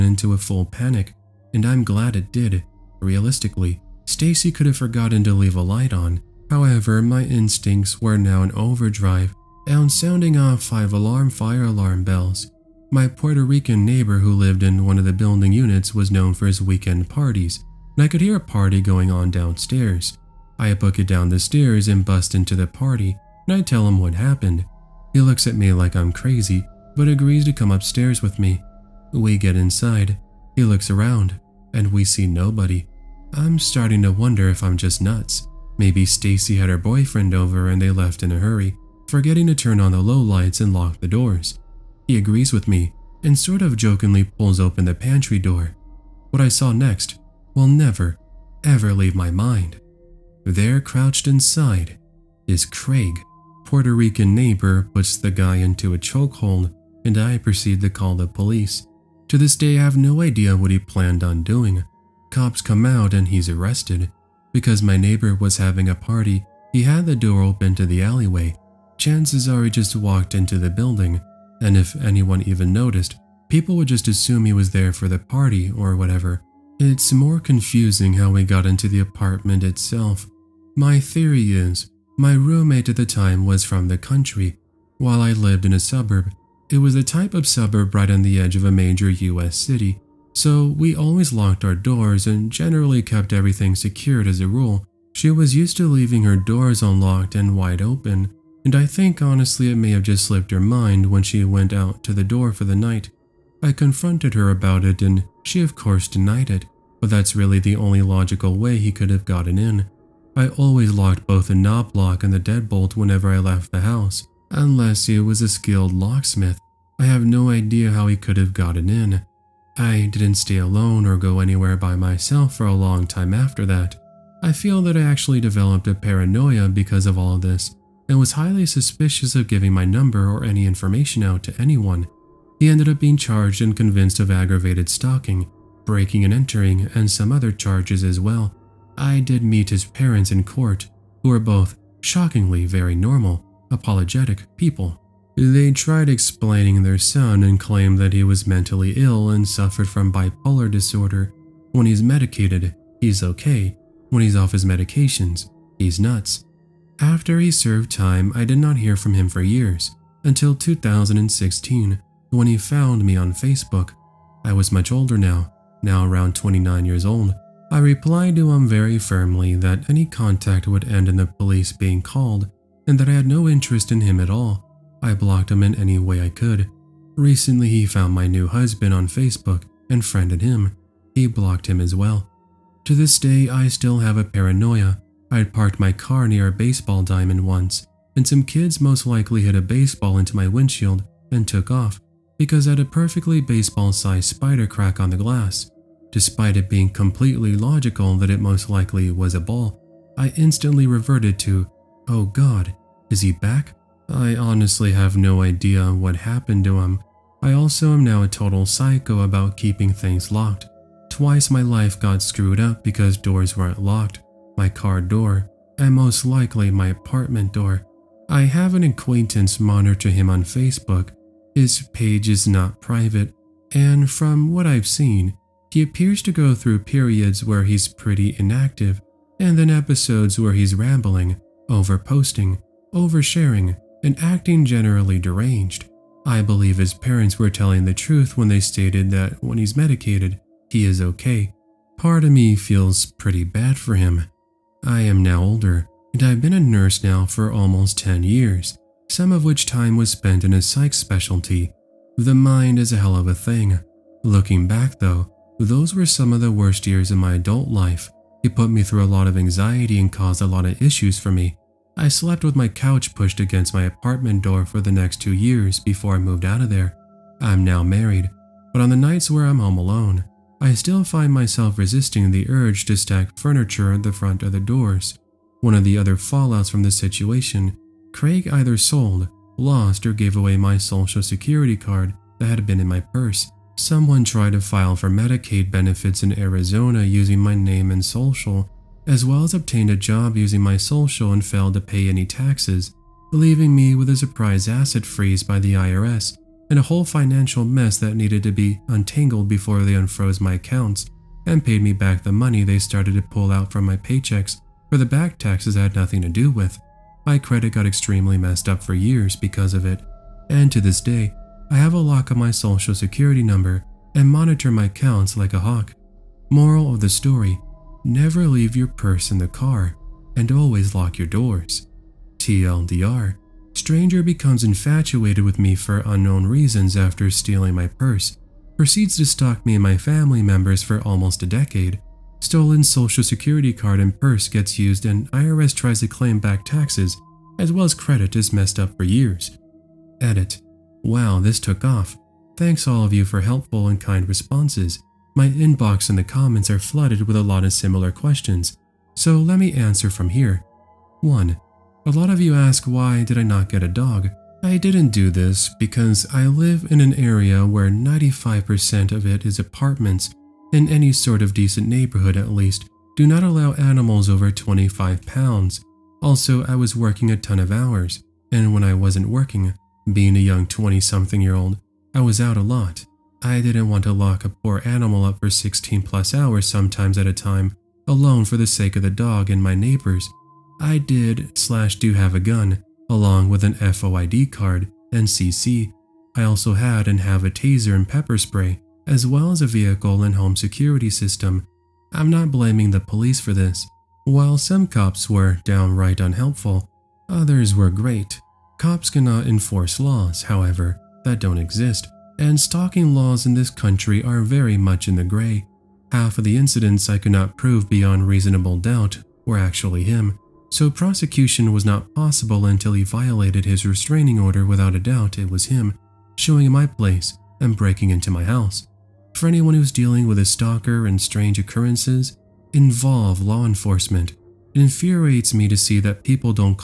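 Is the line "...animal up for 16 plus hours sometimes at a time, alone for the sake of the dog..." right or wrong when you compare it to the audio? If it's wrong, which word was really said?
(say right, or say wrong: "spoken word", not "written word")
right.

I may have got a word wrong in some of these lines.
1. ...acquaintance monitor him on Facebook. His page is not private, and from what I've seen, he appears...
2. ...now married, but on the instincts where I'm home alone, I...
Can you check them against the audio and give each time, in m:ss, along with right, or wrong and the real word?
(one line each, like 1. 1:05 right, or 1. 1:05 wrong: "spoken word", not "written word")
1. 3:38 right
2. 4:27 wrong: "nights", not "instincts".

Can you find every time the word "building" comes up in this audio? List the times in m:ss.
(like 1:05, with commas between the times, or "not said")
0:15, 1:10.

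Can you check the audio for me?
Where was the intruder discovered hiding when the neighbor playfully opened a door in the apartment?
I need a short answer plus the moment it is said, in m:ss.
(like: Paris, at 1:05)
Pantry, at 0:44.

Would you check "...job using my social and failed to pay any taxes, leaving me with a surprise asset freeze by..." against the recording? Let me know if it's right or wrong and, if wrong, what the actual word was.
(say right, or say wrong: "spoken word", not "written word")
right.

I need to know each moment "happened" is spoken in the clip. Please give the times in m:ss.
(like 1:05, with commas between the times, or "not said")
0:24, 3:26.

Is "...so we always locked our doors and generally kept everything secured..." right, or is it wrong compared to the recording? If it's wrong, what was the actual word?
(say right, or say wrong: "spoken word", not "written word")
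right.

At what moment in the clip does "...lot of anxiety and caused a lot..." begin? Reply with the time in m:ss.
4:19.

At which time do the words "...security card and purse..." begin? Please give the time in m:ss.
5:33.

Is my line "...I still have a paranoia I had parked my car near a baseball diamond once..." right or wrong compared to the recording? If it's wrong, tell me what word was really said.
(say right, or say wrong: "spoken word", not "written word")
right.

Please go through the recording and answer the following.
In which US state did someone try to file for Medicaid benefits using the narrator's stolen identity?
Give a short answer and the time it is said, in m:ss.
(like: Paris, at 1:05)
Arizona, at 4:46.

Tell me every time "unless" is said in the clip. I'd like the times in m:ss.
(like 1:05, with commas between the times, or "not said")
1:54.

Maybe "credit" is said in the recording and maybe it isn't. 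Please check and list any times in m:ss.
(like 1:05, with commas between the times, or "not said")
5:07, 5:37.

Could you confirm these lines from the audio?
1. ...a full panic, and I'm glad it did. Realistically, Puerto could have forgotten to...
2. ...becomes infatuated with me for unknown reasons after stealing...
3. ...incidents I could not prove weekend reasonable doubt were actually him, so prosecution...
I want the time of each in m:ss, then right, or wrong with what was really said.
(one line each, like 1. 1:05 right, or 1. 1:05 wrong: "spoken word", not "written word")
1. 0:00 wrong: "Stacy", not "Puerto"
2. 5:24 right
3. 6:46 wrong: "beyond", not "weekend".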